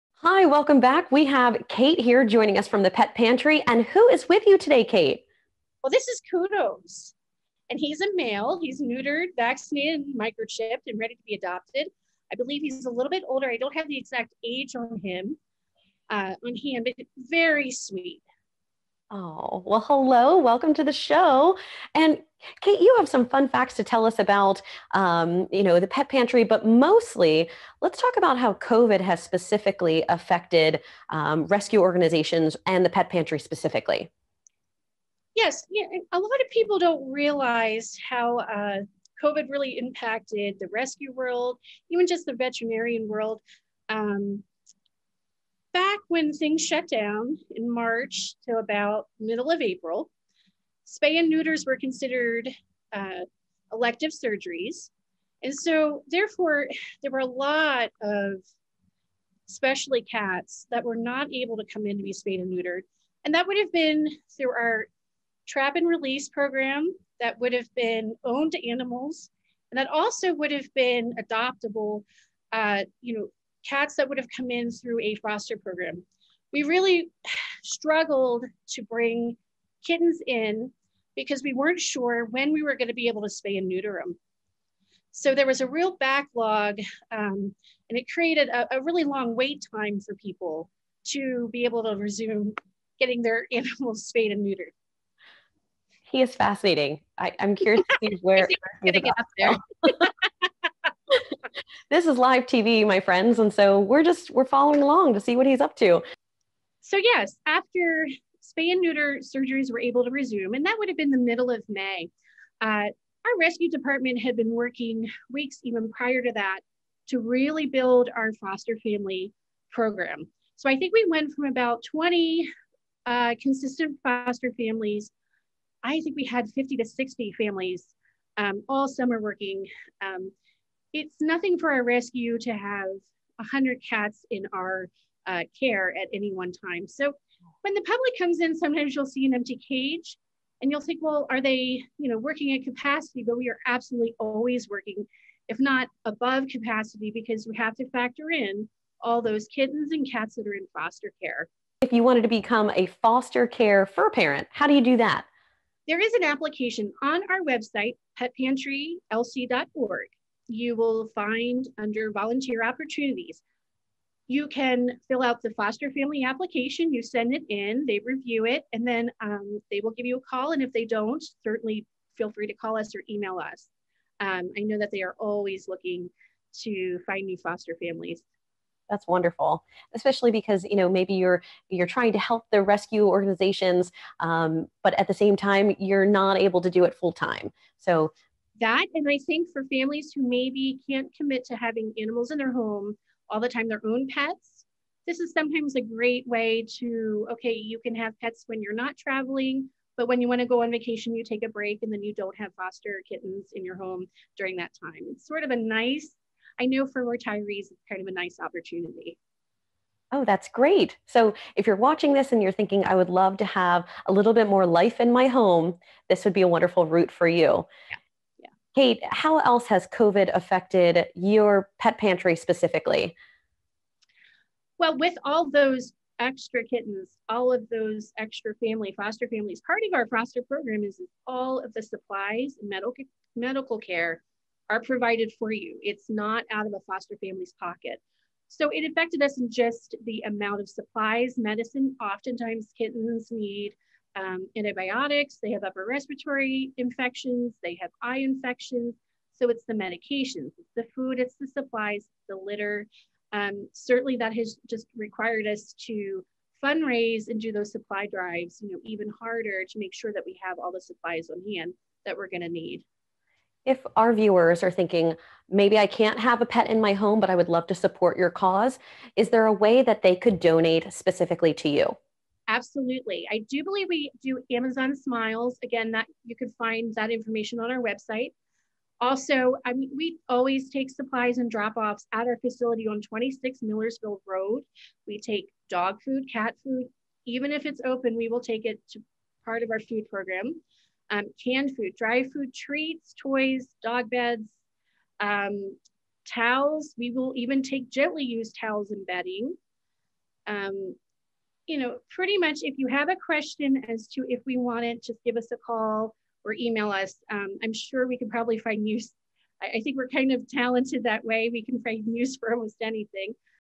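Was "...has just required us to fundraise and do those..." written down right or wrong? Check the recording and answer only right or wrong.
right.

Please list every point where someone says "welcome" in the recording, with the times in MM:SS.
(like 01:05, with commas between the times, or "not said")
00:00, 00:20.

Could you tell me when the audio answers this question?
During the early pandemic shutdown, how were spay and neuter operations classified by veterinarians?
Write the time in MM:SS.
00:53.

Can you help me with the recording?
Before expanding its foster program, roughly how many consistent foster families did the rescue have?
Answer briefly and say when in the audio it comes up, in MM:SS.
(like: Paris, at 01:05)
20, at 02:01.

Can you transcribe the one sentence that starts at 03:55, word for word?
It's not out of a foster family's pocket.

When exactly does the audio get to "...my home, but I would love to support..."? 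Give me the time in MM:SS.
04:26.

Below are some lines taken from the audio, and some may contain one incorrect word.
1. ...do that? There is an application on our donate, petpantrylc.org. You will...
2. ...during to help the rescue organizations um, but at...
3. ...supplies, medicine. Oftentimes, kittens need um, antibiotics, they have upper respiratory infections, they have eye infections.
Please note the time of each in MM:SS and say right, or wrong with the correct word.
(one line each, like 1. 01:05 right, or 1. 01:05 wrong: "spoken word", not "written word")
1. 02:34 wrong: "website", not "donate"
2. 03:01 wrong: "trying", not "during"
3. 04:00 right.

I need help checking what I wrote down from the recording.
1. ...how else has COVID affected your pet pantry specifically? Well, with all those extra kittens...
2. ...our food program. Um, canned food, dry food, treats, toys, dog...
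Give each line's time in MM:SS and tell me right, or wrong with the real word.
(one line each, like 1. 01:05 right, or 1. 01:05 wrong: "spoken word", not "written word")
1. 03:39 right
2. 04:49 right.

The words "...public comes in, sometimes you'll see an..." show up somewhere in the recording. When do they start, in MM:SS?
02:17.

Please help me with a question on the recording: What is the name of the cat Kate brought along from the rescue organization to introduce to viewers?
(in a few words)
Kudos.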